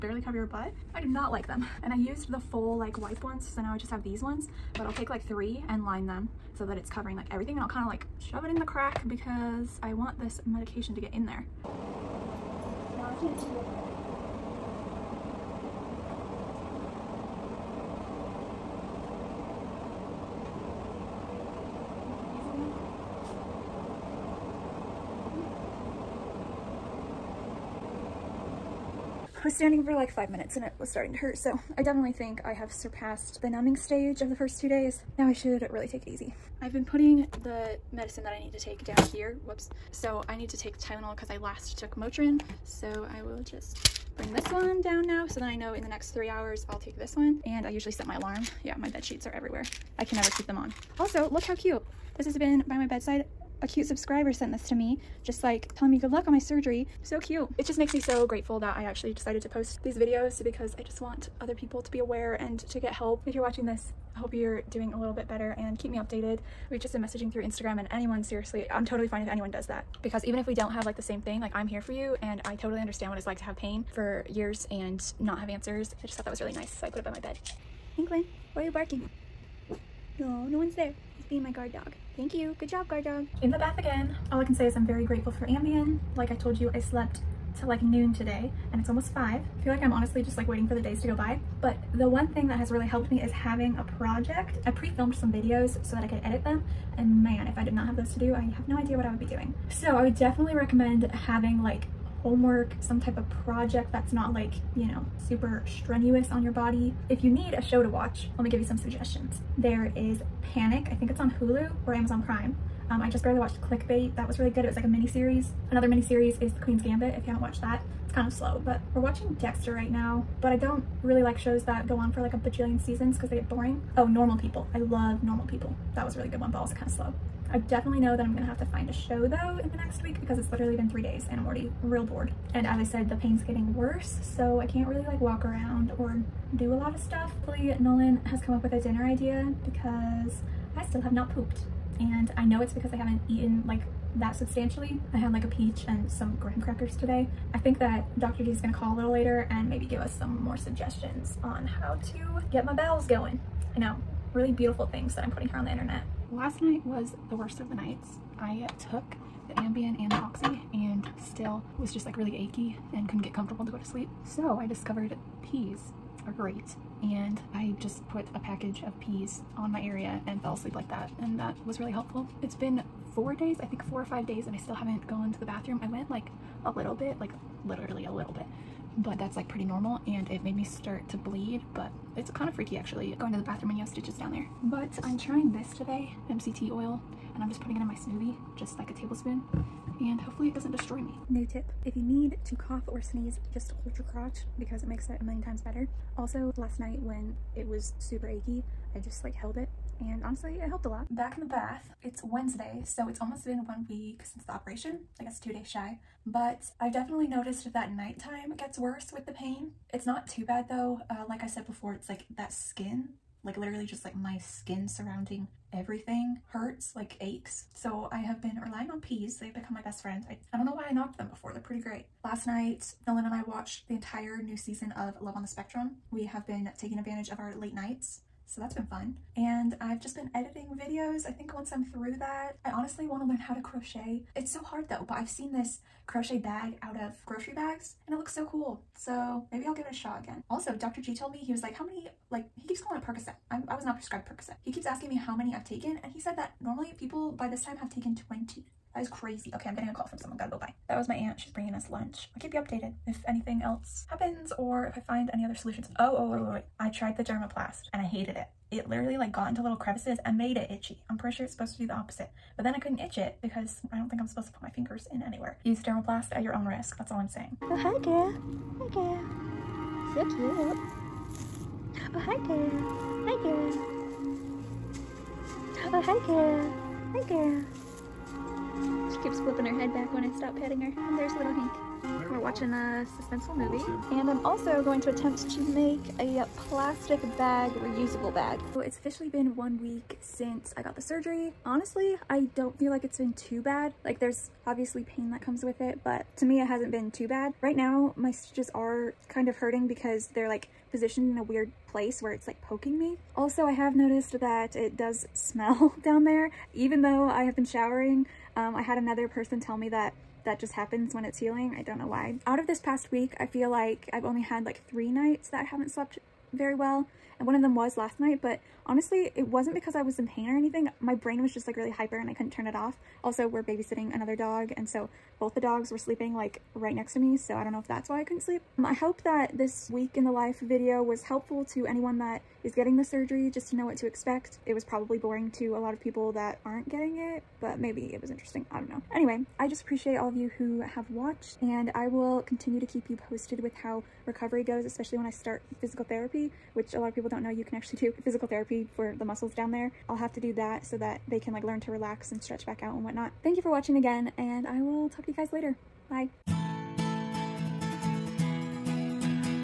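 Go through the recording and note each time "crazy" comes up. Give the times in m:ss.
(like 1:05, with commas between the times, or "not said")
4:09.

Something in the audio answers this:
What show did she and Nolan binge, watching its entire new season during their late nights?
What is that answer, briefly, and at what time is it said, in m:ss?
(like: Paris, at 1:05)
Love on the Spectrum, at 3:45.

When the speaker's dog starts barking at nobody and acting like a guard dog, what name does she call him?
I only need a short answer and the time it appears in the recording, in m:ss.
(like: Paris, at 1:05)
Hinklin, at 1:17.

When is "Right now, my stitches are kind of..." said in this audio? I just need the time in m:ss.
4:57.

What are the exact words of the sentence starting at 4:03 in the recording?
I'm, I was not prescribed Percocet.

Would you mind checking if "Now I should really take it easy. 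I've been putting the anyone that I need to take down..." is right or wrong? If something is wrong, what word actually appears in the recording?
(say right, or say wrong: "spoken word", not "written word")
wrong: "medicine", not "anyone".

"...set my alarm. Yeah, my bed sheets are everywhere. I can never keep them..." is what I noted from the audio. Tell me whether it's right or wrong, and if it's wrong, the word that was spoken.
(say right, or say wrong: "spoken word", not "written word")
right.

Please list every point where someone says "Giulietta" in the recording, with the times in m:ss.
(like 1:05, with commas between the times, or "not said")
not said.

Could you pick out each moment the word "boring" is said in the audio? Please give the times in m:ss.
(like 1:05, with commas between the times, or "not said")
2:03, 5:35.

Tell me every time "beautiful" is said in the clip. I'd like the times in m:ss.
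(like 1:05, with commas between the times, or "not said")
2:34.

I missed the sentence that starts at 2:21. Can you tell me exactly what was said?
And I know it's because I haven't eaten like that substantially.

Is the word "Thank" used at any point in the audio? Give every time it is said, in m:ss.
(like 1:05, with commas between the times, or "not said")
1:22, 5:53.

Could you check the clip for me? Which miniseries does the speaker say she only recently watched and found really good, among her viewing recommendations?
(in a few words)
Clickbait.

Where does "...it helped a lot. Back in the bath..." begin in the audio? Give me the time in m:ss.
3:20.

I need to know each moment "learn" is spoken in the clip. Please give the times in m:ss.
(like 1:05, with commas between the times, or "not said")
3:53, 5:51.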